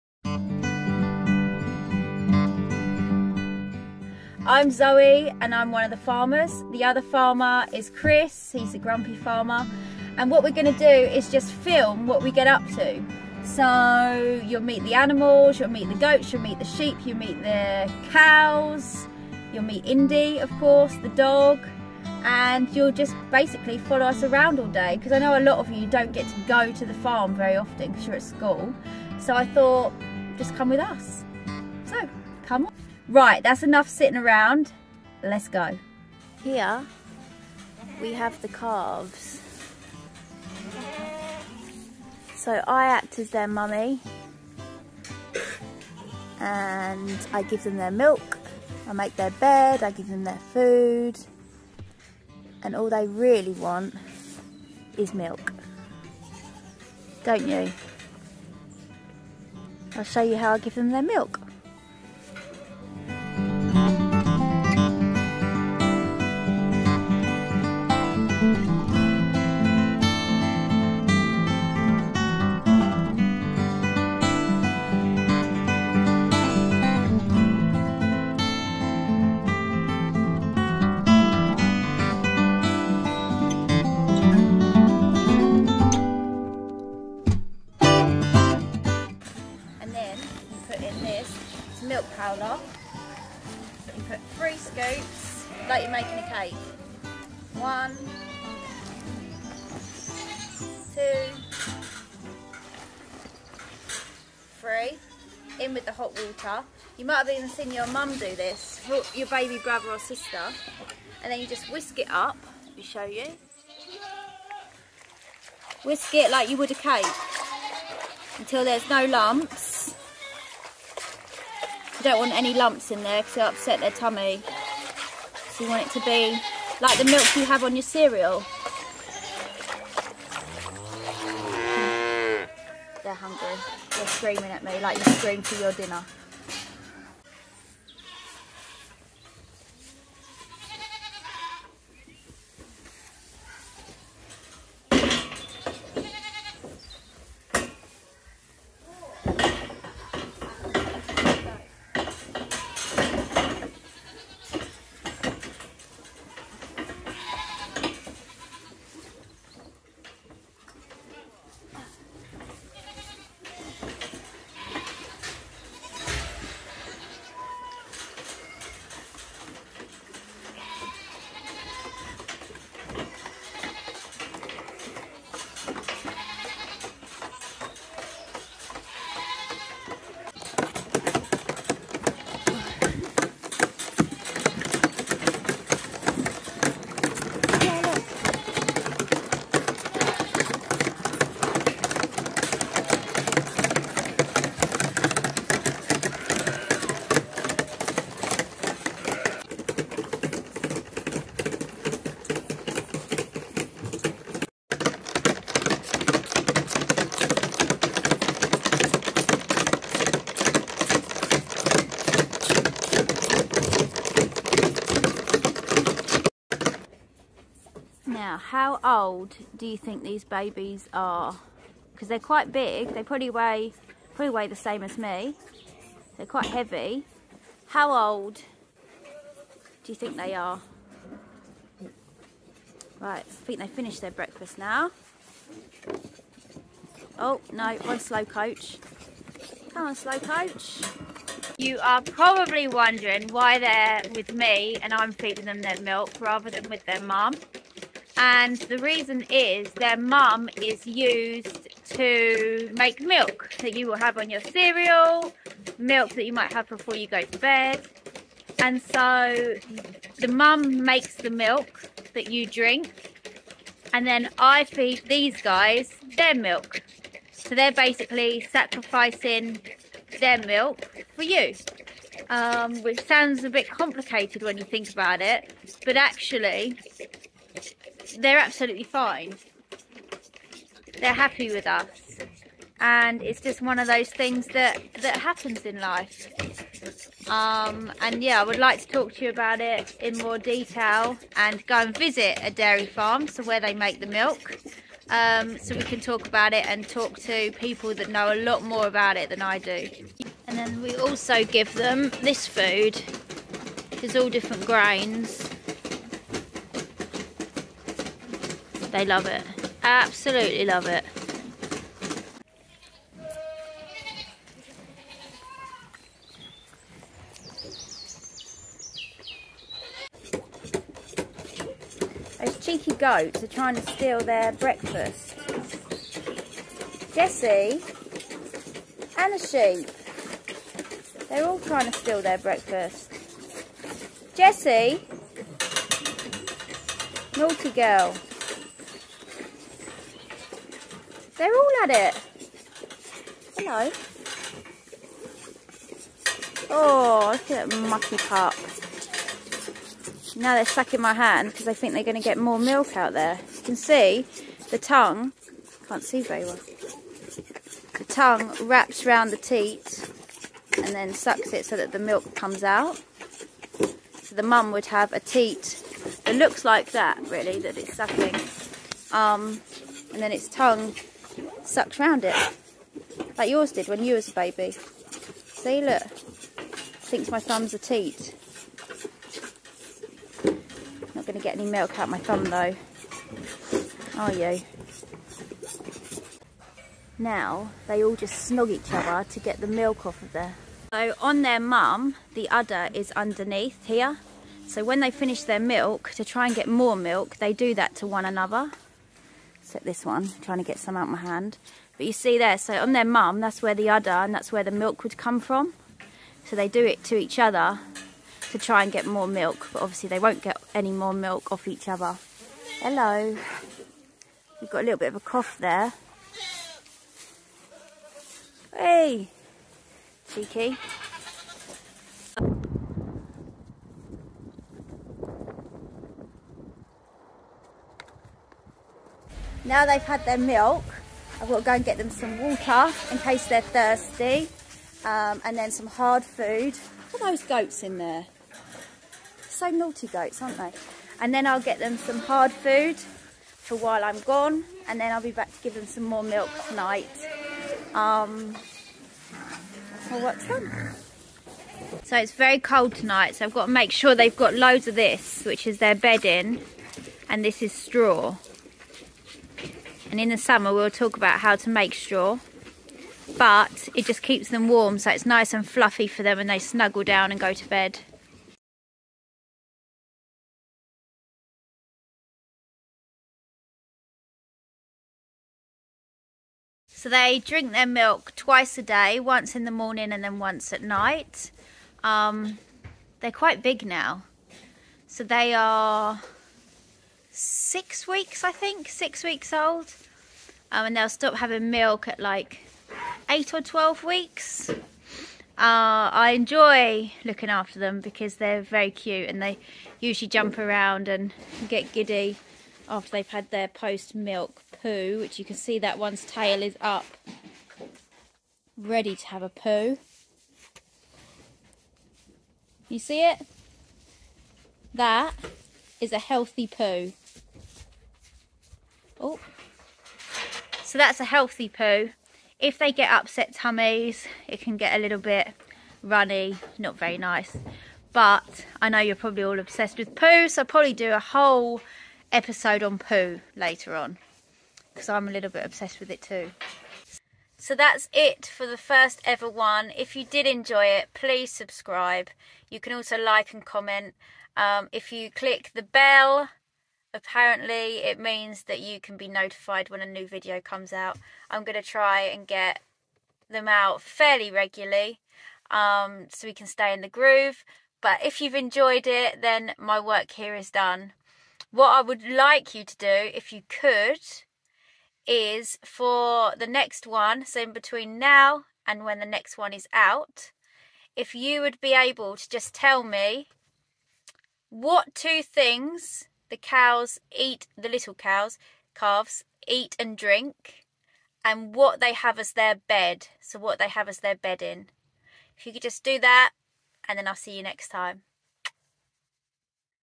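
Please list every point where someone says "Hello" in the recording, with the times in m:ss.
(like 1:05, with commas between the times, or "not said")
5:43, 6:52.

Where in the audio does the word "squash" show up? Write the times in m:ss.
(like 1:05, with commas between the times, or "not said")
not said.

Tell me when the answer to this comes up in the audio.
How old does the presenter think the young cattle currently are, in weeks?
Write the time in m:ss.
8:08.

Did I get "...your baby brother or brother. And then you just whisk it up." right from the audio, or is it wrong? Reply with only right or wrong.
wrong.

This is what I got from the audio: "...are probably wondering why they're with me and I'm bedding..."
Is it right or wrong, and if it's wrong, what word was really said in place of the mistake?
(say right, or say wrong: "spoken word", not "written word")
wrong: "feeding", not "bedding".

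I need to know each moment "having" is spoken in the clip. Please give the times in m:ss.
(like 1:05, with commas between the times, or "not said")
8:11.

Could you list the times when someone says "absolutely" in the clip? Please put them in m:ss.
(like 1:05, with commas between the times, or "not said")
4:38, 5:09.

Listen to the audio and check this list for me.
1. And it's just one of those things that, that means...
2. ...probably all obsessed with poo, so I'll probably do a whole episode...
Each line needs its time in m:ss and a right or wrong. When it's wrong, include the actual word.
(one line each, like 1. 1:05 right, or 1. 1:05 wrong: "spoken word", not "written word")
1. 4:42 wrong: "happens", not "means"
2. 8:49 right.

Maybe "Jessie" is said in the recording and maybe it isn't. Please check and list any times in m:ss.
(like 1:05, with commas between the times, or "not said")
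5:27, 5:34.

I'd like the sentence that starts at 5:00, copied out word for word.
And then we also give them this food, which is all different grains They love it.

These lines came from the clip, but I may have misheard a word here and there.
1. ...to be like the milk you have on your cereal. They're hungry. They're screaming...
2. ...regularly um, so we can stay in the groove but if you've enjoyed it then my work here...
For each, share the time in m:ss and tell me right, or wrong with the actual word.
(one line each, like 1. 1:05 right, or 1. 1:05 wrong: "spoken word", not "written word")
1. 2:05 right
2. 9:14 right.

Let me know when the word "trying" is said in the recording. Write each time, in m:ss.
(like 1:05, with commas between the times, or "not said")
5:23, 5:31, 6:40.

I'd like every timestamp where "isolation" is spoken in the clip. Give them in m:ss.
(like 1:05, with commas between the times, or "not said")
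not said.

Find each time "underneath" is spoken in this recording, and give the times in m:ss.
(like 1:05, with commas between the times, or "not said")
6:33.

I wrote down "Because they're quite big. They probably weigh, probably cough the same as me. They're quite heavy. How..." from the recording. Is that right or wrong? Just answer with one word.
wrong.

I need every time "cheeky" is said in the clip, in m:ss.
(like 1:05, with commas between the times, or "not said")
5:22, 7:00.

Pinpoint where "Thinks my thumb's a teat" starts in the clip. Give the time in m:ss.
6:16.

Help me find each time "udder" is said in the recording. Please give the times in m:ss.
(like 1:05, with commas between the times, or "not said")
6:32, 6:43.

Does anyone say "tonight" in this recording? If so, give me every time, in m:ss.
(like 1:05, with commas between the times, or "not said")
7:26, 7:32.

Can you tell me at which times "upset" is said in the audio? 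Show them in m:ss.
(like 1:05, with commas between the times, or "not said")
2:03, 8:43.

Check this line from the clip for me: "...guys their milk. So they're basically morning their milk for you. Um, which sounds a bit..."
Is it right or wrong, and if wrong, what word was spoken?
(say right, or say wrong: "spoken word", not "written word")
wrong: "sacrificing", not "morning".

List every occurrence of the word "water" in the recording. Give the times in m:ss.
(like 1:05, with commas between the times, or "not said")
1:46, 7:12.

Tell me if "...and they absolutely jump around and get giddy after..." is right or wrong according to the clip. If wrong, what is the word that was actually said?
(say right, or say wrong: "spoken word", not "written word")
wrong: "usually", not "absolutely".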